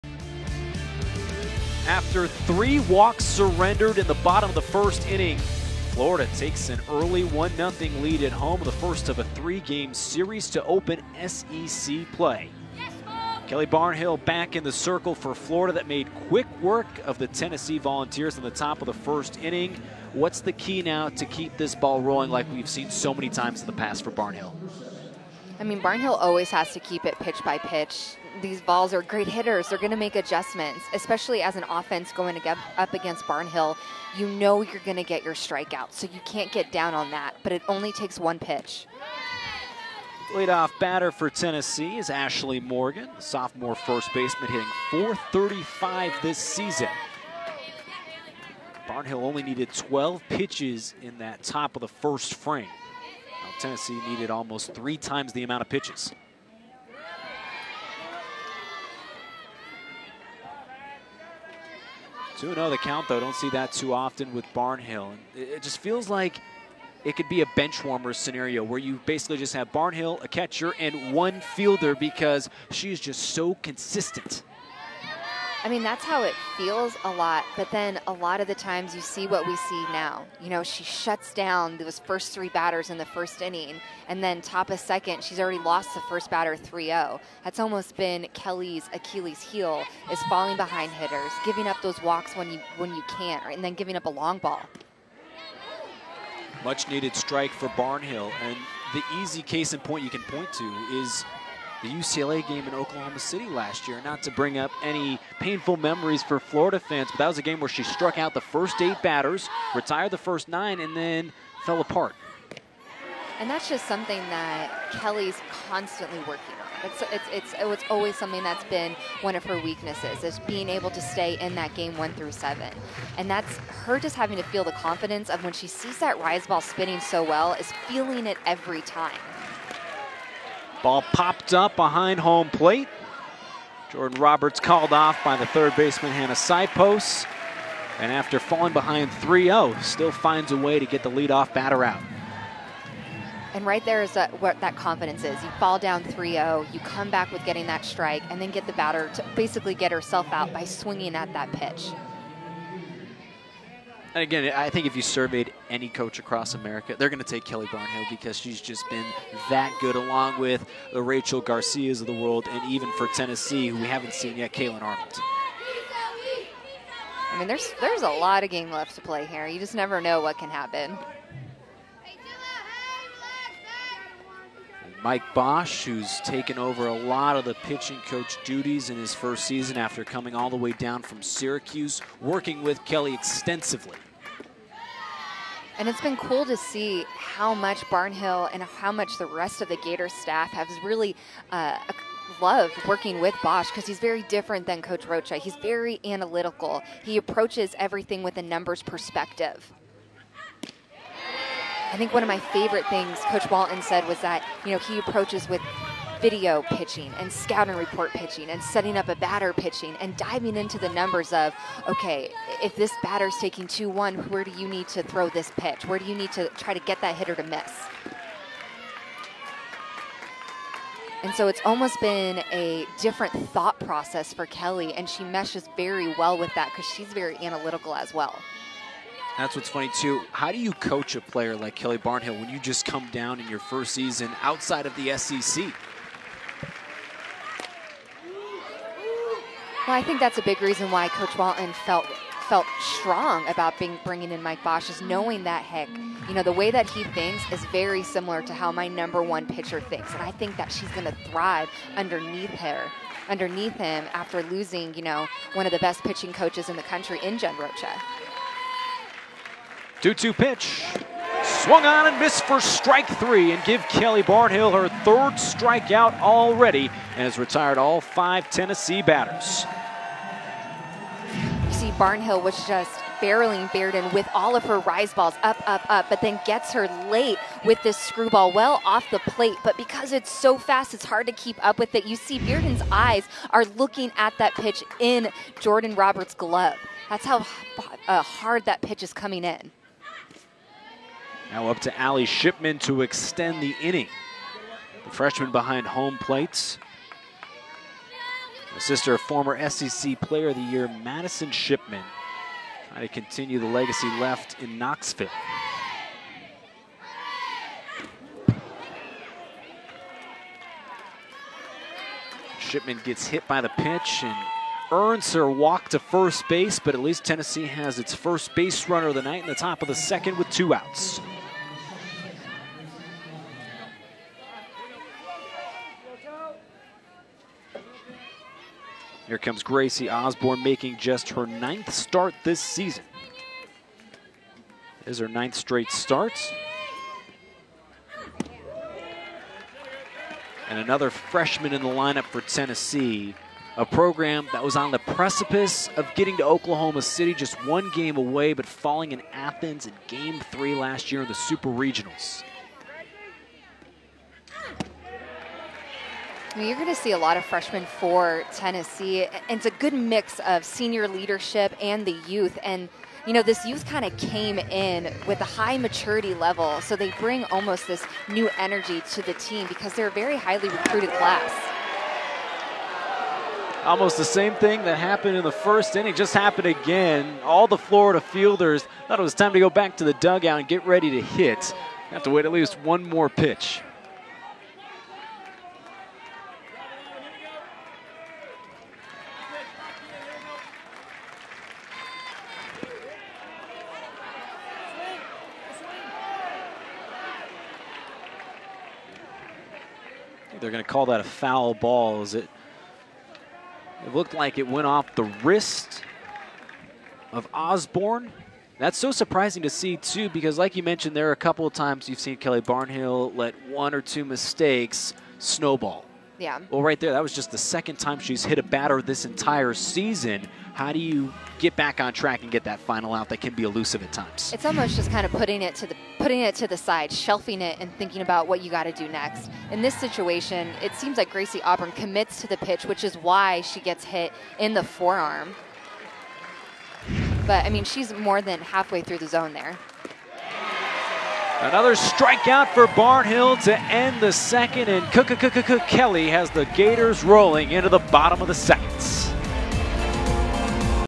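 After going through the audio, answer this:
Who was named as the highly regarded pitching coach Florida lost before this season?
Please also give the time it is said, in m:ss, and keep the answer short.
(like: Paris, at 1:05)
Jen Rocha, at 4:17.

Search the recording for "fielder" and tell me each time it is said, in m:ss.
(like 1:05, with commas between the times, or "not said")
1:11, 6:18.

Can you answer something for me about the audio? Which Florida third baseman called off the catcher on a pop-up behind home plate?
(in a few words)
Hannah Sipos.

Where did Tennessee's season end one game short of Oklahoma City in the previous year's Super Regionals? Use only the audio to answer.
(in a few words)
Athens.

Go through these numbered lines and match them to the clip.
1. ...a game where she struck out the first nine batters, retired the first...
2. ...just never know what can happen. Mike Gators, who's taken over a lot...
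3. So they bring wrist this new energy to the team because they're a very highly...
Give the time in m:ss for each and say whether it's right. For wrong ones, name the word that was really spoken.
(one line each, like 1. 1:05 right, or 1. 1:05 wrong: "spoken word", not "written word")
1. 1:47 wrong: "eight", not "nine"
2. 2:49 wrong: "Bosch", not "Gators"
3. 6:06 wrong: "almost", not "wrist".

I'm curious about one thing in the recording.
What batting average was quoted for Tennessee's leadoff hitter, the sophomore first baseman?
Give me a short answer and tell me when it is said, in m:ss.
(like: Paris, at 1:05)
.435, at 0:44.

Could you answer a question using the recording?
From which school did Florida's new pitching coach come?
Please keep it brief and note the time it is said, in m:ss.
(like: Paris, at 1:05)
Syracuse, at 3:01.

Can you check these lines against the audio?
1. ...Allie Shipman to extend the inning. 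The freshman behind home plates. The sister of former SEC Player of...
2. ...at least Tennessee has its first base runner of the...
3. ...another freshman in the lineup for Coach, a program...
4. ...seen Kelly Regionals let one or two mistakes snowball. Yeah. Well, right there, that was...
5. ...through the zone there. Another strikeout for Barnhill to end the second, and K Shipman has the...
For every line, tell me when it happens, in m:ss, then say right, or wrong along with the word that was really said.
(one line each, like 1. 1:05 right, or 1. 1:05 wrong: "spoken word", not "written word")
1. 4:51 right
2. 5:16 right
3. 5:40 wrong: "Tennessee", not "Coach"
4. 6:52 wrong: "Barnhill", not "Regionals"
5. 7:19 wrong: "Kelly", not "Shipman".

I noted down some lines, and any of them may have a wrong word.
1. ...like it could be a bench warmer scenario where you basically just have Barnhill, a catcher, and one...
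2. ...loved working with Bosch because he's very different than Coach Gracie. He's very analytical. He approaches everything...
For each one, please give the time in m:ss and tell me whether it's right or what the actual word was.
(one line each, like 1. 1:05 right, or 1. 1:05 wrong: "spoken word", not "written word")
1. 1:06 right
2. 3:12 wrong: "Rocha", not "Gracie".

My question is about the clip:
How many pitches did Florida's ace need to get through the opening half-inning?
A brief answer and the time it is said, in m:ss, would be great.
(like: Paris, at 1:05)
12, at 0:49.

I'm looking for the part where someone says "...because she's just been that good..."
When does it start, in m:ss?
2:38.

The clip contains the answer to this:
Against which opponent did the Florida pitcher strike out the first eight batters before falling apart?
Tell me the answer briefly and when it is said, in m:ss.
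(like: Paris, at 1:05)
UCLA, at 1:41.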